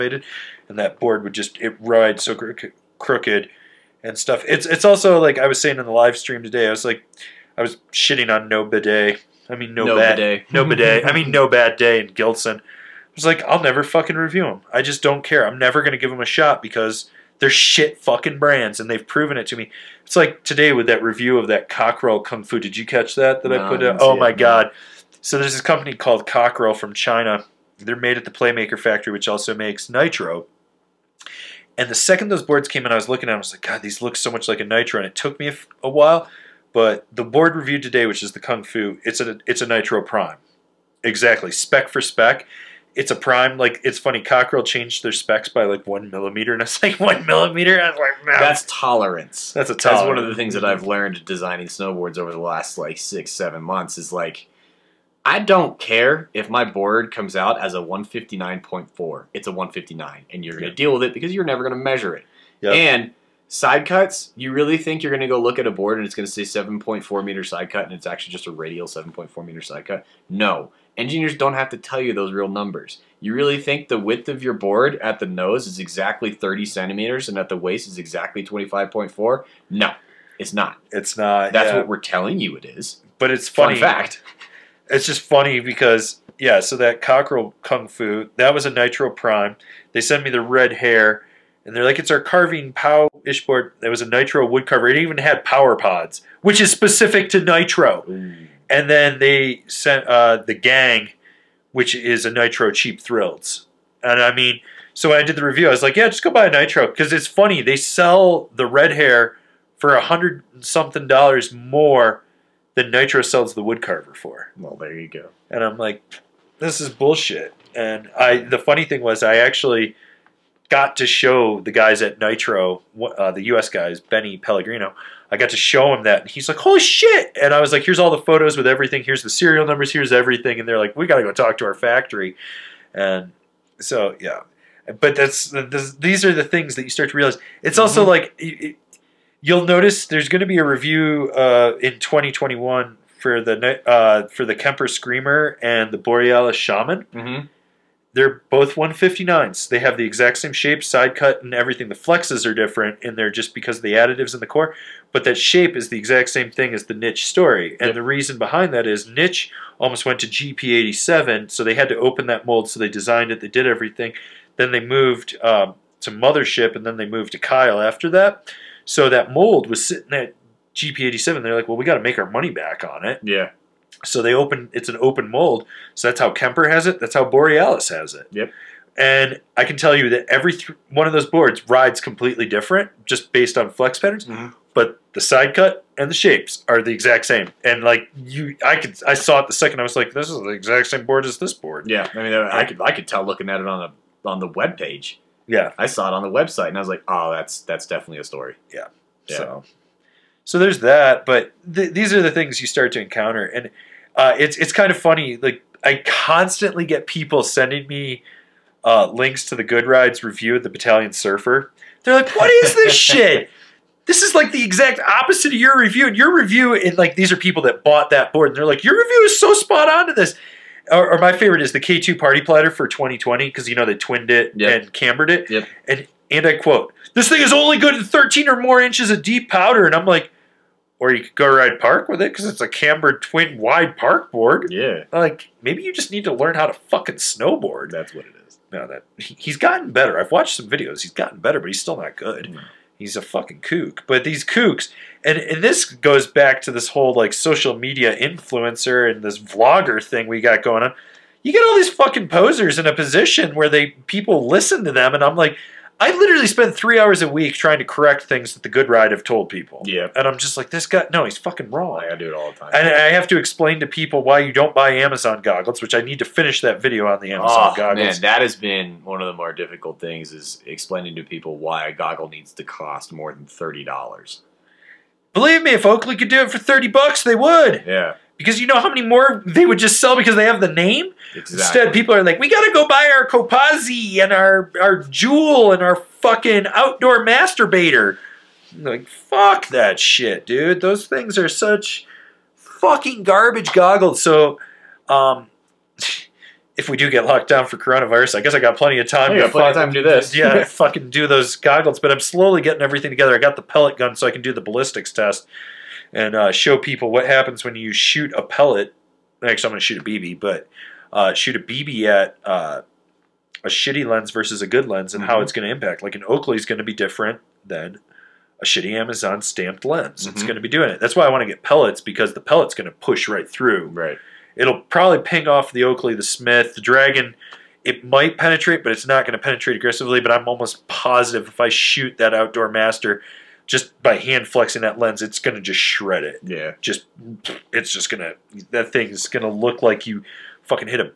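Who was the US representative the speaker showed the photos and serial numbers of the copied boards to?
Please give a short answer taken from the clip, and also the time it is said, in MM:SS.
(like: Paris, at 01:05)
Benny Pellegrino, at 02:03.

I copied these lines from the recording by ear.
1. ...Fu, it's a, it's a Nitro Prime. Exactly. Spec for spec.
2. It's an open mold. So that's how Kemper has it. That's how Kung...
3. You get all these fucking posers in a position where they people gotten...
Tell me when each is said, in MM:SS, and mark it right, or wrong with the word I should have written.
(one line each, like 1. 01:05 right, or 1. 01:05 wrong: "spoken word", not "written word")
1. 00:38 right
2. 02:54 wrong: "Borealis", not "Kung"
3. 04:11 wrong: "listen", not "gotten".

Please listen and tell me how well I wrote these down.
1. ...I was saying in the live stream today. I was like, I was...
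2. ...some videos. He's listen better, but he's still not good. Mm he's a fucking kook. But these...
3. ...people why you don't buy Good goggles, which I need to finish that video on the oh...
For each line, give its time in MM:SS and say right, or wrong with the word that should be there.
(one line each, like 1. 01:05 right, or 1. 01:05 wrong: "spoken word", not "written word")
1. 00:05 right
2. 04:00 wrong: "gotten", not "listen"
3. 04:23 wrong: "Amazon", not "Good".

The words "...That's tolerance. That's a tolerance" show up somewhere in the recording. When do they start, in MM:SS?
00:48.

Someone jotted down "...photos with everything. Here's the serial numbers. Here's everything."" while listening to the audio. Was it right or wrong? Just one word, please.
right.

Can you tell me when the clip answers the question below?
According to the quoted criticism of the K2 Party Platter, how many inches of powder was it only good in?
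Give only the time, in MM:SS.
03:48.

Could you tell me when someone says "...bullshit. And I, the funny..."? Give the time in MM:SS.
01:56.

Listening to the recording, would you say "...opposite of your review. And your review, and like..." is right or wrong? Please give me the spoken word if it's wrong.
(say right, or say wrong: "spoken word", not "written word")
right.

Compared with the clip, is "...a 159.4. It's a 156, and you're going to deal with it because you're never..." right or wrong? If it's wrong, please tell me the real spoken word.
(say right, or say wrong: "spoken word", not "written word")
wrong: "159", not "156".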